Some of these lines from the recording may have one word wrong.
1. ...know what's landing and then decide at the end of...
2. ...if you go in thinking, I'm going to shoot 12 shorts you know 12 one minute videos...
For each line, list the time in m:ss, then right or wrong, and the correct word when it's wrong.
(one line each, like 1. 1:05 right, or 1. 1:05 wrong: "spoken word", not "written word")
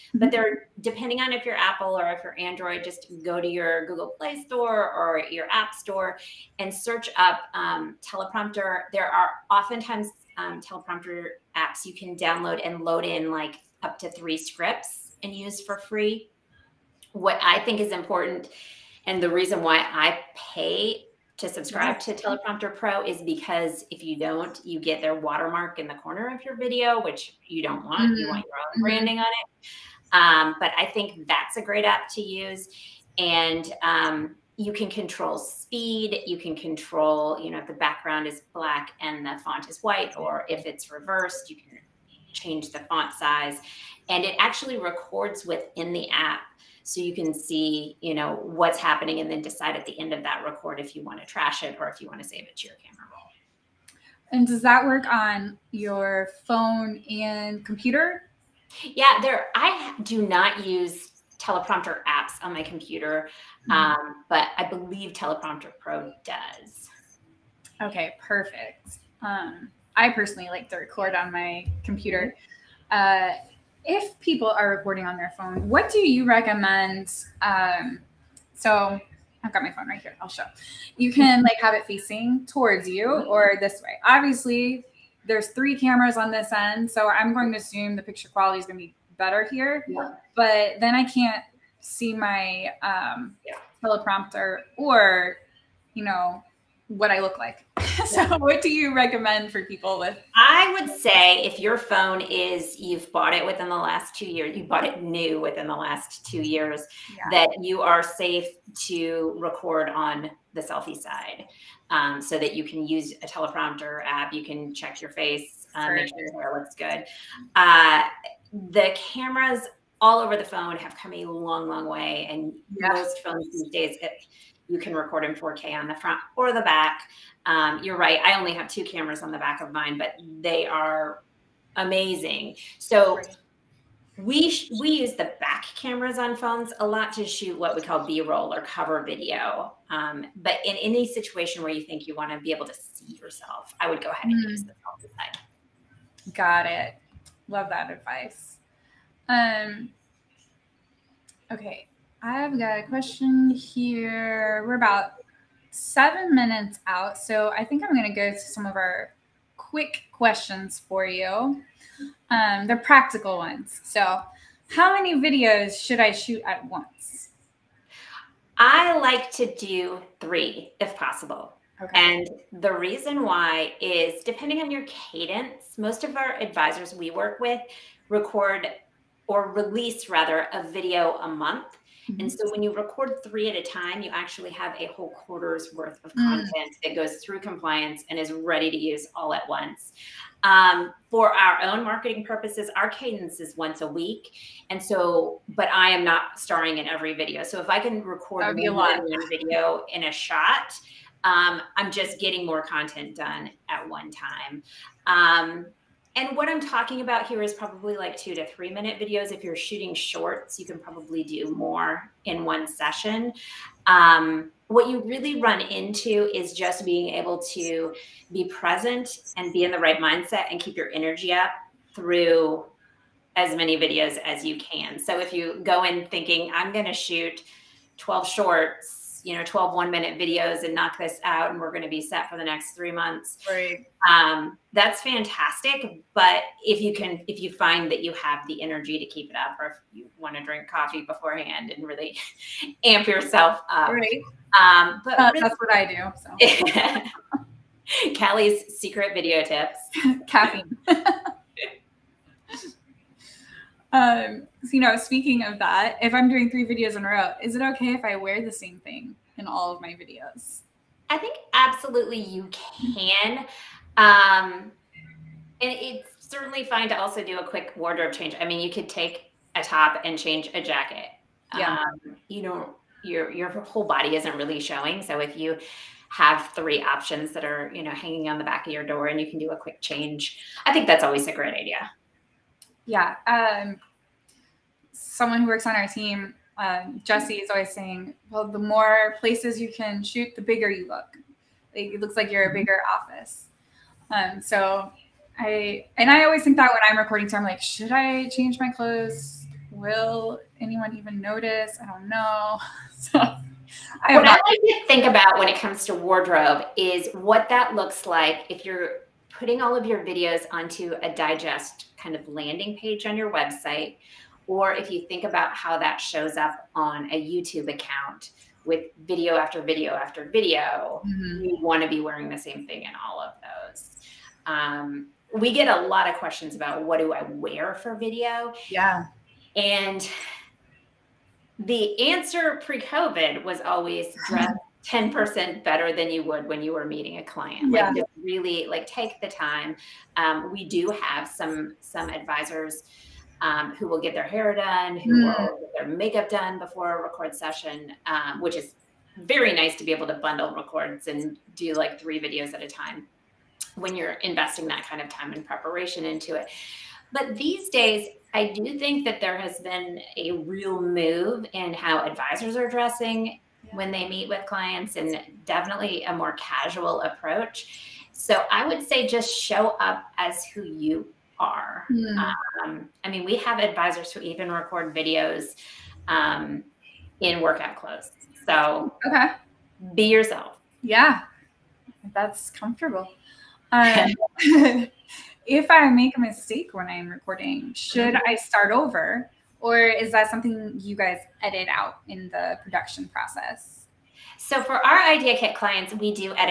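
1. 0:48 wrong: "happening", not "landing"
2. 3:45 right.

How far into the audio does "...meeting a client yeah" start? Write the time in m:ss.
5:36.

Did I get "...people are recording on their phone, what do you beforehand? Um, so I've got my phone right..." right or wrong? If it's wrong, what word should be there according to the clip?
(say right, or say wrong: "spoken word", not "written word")
wrong: "recommend", not "beforehand".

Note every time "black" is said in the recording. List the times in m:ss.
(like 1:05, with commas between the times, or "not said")
0:38.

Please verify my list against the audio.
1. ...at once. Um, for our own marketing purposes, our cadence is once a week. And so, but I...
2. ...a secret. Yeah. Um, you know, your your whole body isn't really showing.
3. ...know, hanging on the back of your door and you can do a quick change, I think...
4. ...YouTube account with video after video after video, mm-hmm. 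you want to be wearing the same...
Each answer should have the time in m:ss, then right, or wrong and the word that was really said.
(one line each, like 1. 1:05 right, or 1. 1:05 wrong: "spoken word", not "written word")
1. 3:09 right
2. 4:30 wrong: "jacket", not "secret"
3. 4:37 right
4. 5:17 right.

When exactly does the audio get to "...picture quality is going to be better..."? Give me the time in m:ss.
1:28.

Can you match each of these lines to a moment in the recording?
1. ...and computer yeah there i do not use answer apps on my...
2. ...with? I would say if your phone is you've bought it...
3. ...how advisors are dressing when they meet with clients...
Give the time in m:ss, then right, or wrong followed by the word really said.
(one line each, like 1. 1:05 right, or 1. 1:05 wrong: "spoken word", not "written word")
1. 0:57 wrong: "teleprompter", not "answer"
2. 1:39 right
3. 6:01 right.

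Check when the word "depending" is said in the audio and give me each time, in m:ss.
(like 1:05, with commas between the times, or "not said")
0:00, 2:54.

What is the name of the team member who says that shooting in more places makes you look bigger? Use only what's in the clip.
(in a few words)
Jesse.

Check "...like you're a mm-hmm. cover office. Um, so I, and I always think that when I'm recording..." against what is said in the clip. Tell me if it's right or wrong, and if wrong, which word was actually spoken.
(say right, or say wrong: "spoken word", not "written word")
wrong: "bigger", not "cover".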